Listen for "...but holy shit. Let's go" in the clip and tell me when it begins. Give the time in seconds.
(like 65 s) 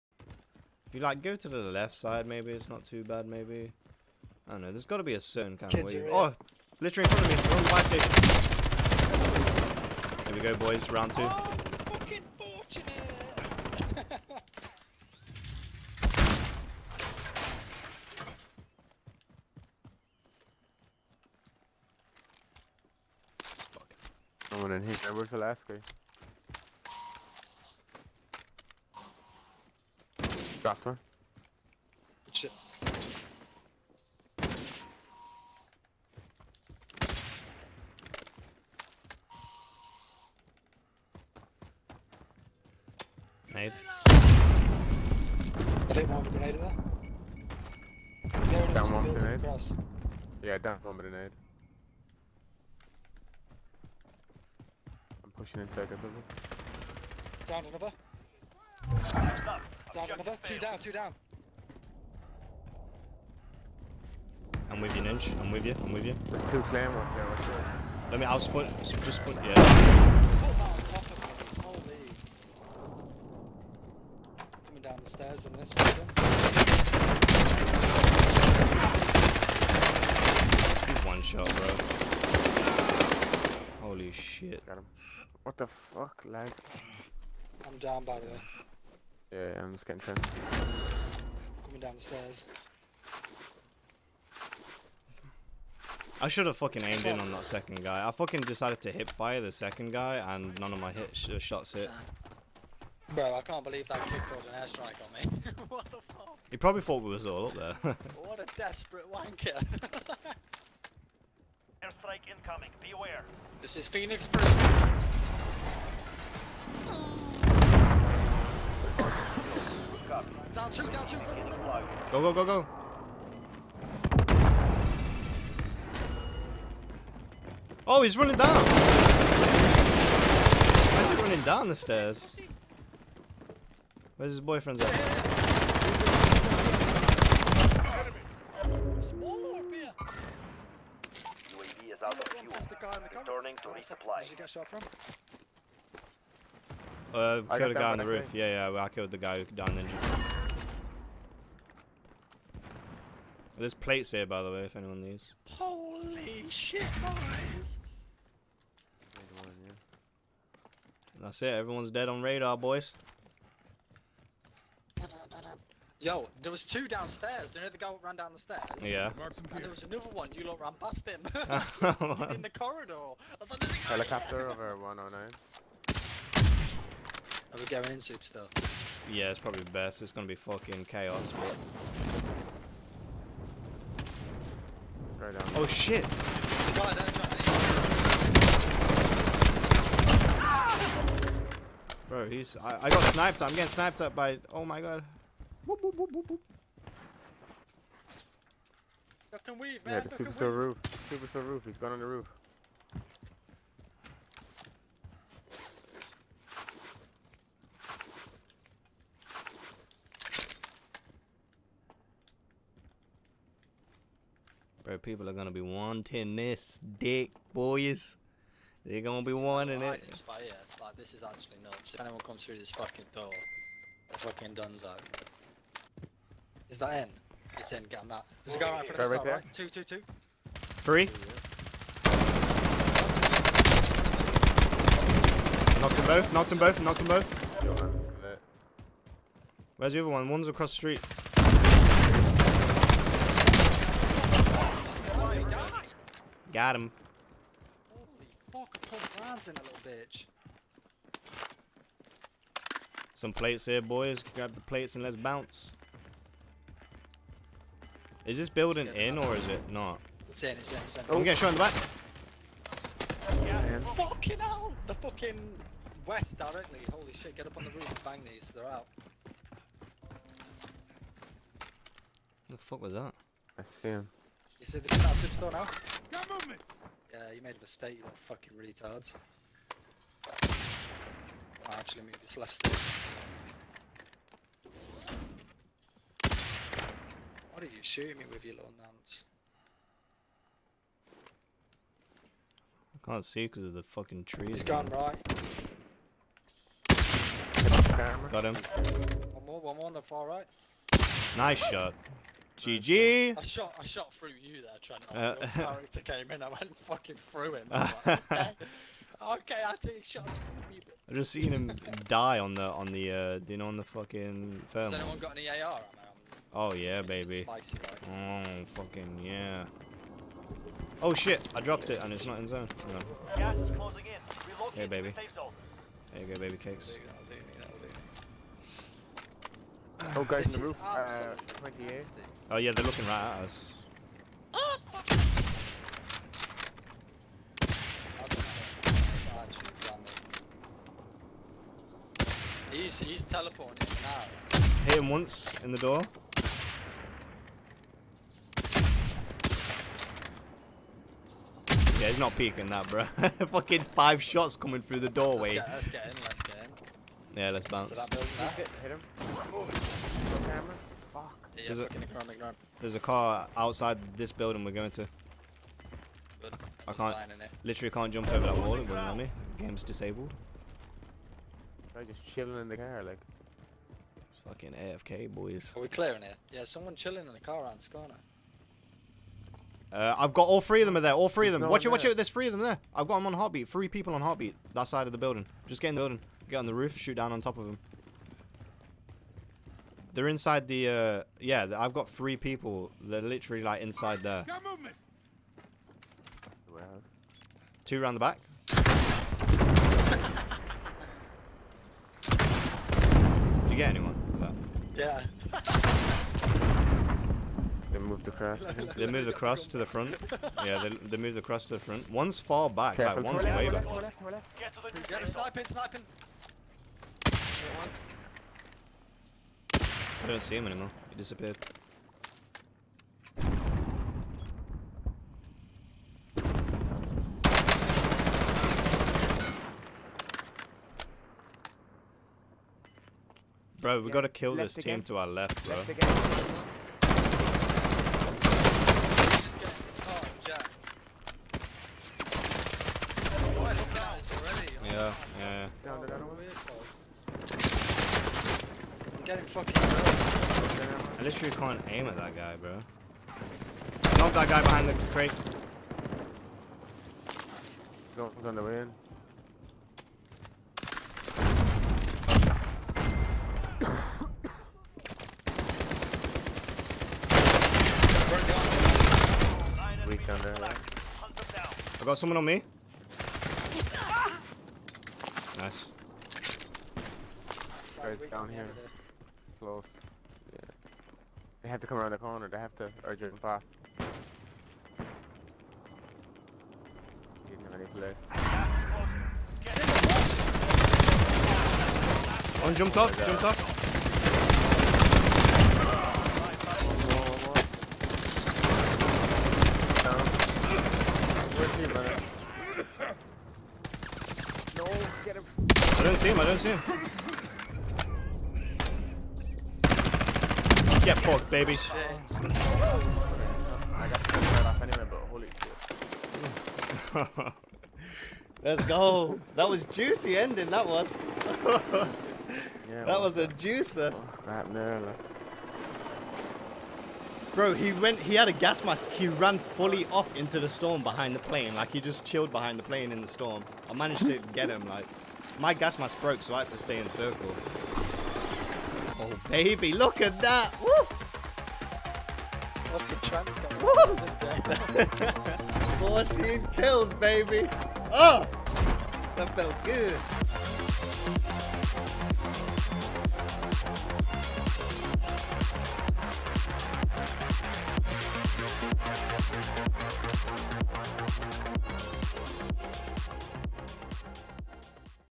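515 s.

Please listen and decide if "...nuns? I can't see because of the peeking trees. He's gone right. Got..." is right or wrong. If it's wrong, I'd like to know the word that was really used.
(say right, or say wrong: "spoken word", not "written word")
wrong: "fucking", not "peeking".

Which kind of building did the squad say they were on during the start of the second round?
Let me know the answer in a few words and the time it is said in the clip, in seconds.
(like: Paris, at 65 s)
Fire station, at 7 s.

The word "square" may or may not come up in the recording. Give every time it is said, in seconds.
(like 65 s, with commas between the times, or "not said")
not said.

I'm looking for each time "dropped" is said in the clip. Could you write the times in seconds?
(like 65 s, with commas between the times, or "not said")
30 s, 321 s.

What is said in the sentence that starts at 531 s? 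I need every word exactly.
Like, he just chilled behind the plane in the storm.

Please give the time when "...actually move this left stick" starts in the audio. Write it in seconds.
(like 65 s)
281 s.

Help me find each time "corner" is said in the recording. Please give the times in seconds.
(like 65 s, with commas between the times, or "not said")
377 s, 482 s.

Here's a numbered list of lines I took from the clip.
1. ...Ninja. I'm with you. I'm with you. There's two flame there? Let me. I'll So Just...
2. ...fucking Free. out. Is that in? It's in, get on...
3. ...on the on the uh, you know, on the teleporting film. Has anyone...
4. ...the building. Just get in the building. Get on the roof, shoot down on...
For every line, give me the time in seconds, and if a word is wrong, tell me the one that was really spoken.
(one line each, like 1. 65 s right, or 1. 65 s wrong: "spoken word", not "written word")
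1. 65 s right
2. 224 s wrong: "Dunzo", not "Free"
3. 312 s wrong: "fucking", not "teleporting"
4. 385 s right.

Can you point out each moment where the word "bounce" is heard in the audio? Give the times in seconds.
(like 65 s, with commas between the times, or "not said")
255 s, 357 s.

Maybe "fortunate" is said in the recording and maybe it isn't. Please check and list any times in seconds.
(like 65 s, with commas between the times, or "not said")
12 s.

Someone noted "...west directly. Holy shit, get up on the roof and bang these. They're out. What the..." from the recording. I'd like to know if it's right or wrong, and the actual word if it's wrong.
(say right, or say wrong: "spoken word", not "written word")
right.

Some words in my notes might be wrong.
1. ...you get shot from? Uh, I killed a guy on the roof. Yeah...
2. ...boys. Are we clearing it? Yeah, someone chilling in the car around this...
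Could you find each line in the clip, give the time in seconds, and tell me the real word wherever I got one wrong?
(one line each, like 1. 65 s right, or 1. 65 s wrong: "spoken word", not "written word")
1. 144 s right
2. 375 s right.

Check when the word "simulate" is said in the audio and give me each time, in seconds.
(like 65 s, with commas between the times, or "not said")
not said.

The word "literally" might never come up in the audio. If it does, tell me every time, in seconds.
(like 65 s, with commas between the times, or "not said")
6 s, 367 s, 393 s, 451 s.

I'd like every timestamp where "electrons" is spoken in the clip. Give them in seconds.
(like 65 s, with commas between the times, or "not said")
not said.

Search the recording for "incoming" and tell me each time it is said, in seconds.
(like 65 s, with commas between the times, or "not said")
112 s.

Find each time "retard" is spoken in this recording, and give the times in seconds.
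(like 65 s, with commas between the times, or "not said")
278 s.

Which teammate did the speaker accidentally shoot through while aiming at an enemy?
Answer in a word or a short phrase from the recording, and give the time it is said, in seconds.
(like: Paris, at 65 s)
Trent, at 304 s.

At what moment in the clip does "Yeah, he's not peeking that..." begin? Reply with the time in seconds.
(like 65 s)
352 s.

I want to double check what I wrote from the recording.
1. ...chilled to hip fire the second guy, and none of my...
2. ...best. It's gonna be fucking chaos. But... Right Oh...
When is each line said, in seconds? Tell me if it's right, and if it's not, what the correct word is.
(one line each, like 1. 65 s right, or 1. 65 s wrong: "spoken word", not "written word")
1. 98 s wrong: "decided", not "chilled"
2. 179 s right.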